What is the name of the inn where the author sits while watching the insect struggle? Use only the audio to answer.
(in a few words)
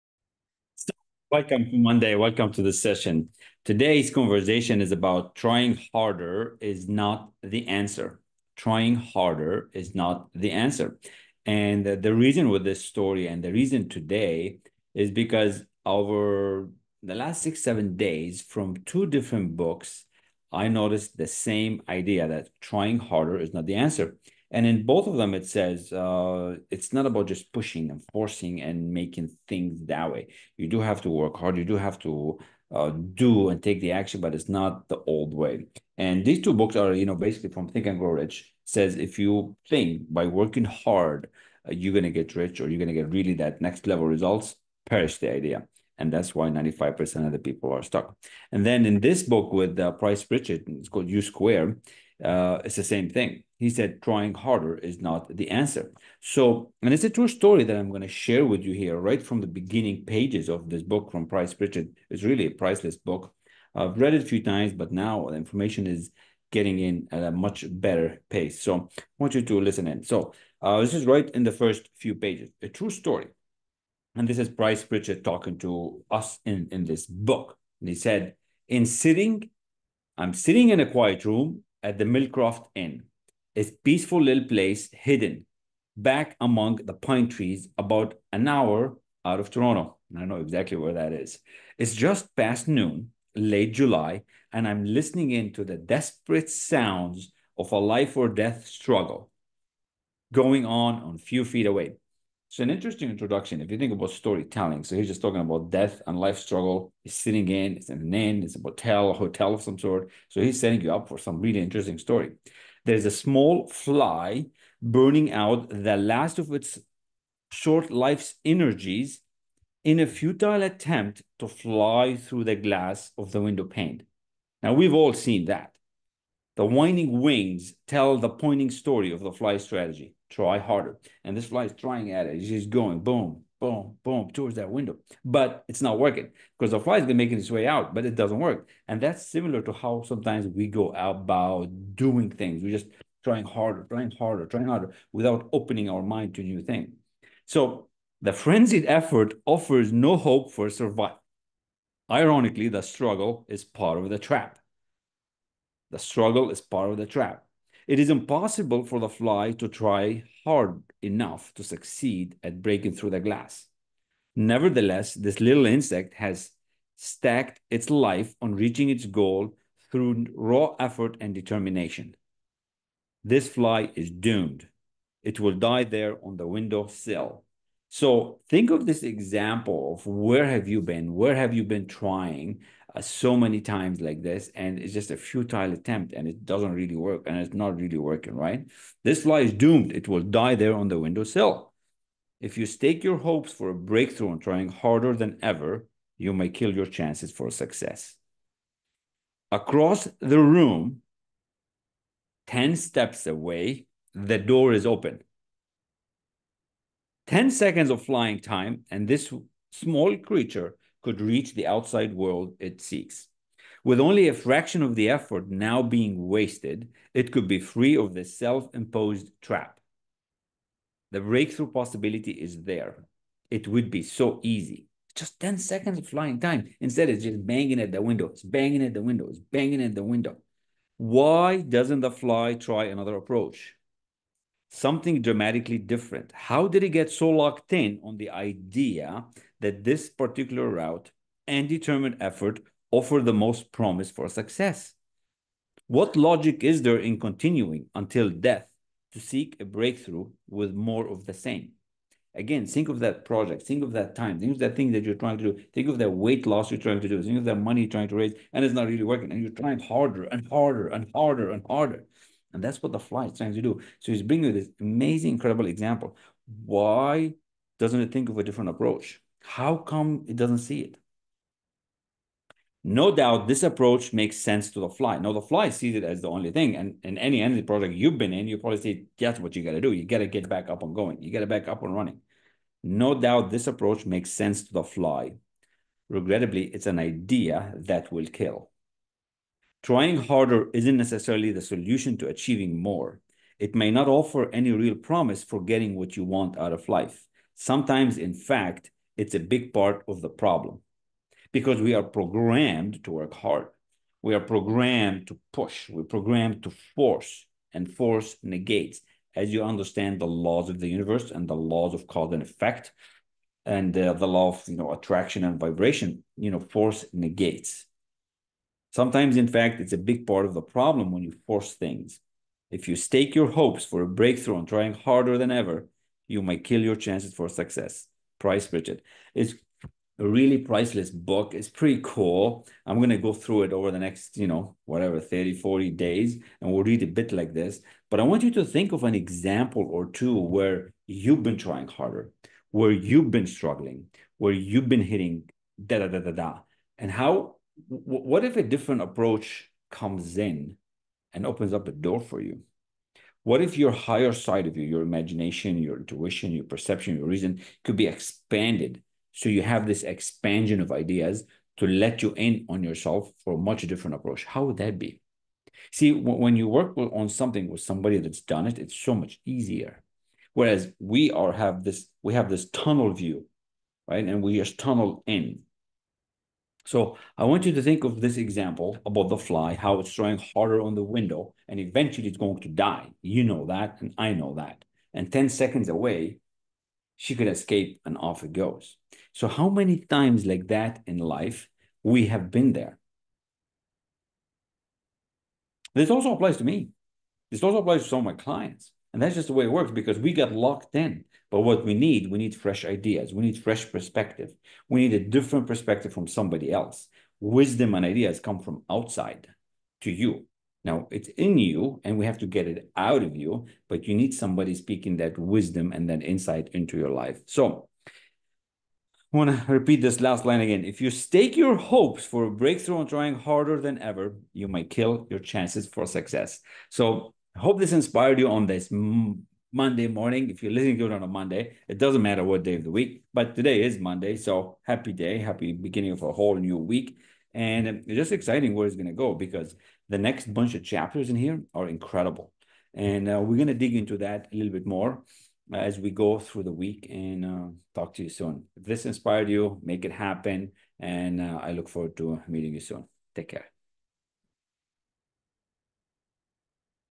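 Millcroft Inn.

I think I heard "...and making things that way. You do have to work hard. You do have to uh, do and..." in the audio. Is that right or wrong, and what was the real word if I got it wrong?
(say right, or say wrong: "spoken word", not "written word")
right.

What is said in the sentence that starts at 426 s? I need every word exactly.
So I hope this inspired you on this Monday morning.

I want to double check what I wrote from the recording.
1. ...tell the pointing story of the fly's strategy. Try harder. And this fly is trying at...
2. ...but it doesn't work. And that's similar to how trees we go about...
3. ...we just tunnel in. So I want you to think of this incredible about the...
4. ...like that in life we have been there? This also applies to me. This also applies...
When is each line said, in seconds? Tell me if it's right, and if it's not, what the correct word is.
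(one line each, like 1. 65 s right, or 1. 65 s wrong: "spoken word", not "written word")
1. 127 s right
2. 137 s wrong: "sometimes", not "trees"
3. 374 s wrong: "example", not "incredible"
4. 390 s right.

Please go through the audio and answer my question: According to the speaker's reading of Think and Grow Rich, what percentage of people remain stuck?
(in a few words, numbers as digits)
95%.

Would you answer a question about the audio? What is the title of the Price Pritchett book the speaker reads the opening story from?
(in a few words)
U Square.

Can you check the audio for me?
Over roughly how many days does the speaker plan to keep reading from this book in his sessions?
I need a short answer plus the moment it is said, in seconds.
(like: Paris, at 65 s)
30 to 40 days, at 335 s.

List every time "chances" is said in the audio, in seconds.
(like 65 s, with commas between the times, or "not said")
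196 s, 326 s, 425 s.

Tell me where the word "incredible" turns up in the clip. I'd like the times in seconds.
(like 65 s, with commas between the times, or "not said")
265 s, 441 s.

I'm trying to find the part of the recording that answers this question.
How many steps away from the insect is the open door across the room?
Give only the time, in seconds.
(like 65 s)
202 s.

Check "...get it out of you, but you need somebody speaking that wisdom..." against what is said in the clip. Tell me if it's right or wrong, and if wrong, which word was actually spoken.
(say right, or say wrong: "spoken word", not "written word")
right.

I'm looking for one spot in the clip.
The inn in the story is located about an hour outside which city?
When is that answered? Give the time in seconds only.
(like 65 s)
89 s.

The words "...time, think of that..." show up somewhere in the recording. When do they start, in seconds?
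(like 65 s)
254 s.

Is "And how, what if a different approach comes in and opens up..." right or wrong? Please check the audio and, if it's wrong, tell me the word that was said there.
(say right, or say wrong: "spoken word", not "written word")
right.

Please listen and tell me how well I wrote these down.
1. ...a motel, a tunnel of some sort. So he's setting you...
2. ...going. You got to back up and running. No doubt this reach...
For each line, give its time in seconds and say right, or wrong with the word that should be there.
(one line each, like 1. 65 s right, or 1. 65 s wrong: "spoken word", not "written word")
1. 108 s wrong: "hotel", not "tunnel"
2. 280 s wrong: "approach", not "reach".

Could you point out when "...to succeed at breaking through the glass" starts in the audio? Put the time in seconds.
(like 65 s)
161 s.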